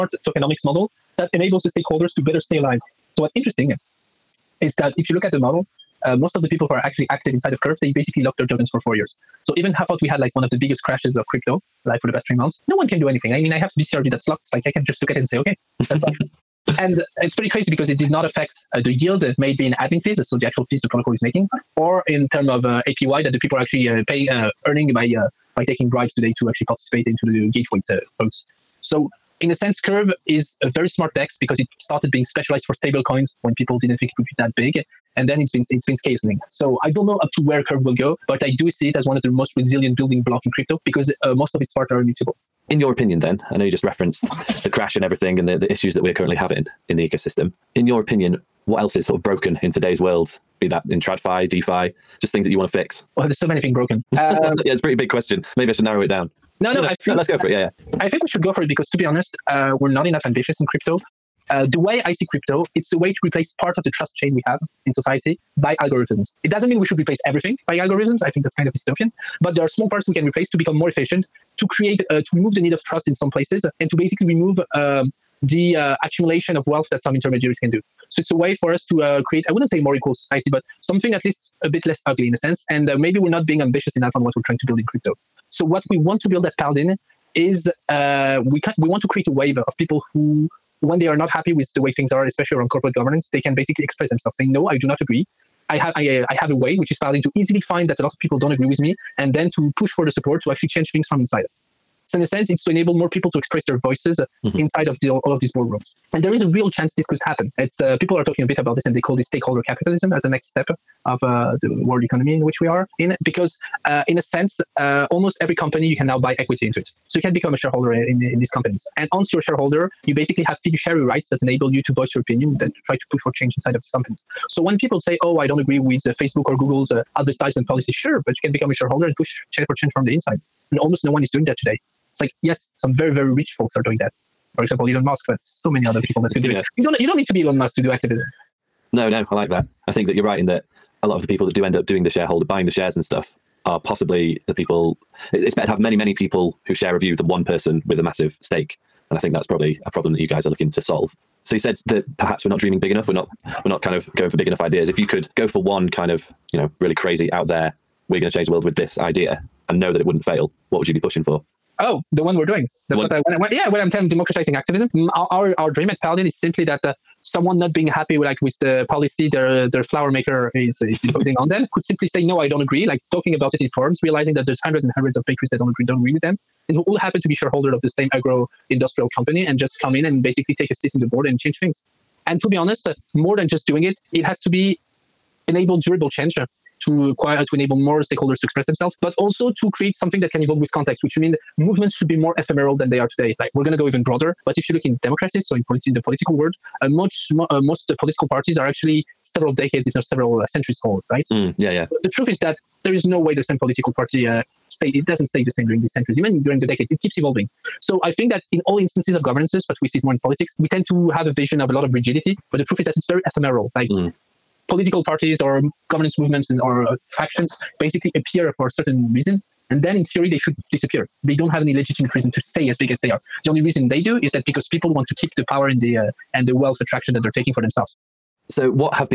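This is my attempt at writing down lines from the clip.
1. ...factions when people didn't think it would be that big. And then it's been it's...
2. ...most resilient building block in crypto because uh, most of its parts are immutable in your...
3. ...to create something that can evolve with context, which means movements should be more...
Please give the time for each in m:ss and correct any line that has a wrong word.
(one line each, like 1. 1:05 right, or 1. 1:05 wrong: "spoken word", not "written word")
1. 0:33 wrong: "coins", not "factions"
2. 0:39 right
3. 3:09 right.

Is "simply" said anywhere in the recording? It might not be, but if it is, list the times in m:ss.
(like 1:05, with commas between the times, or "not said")
2:46, 2:51.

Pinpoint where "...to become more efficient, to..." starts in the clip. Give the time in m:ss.
1:10.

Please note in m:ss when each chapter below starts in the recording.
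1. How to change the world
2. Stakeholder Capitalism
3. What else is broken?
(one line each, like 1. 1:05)
1. 2:39
2. 1:47
3. 0:47.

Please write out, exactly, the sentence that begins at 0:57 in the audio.
I think we should go for it because, to be honest, uh, we're not enough ambitious in crypto.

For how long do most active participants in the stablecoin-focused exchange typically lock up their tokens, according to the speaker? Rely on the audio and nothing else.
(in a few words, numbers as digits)
4 years.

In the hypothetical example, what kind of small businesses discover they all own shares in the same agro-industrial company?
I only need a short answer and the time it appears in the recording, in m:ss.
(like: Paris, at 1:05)
bakeries, at 2:55.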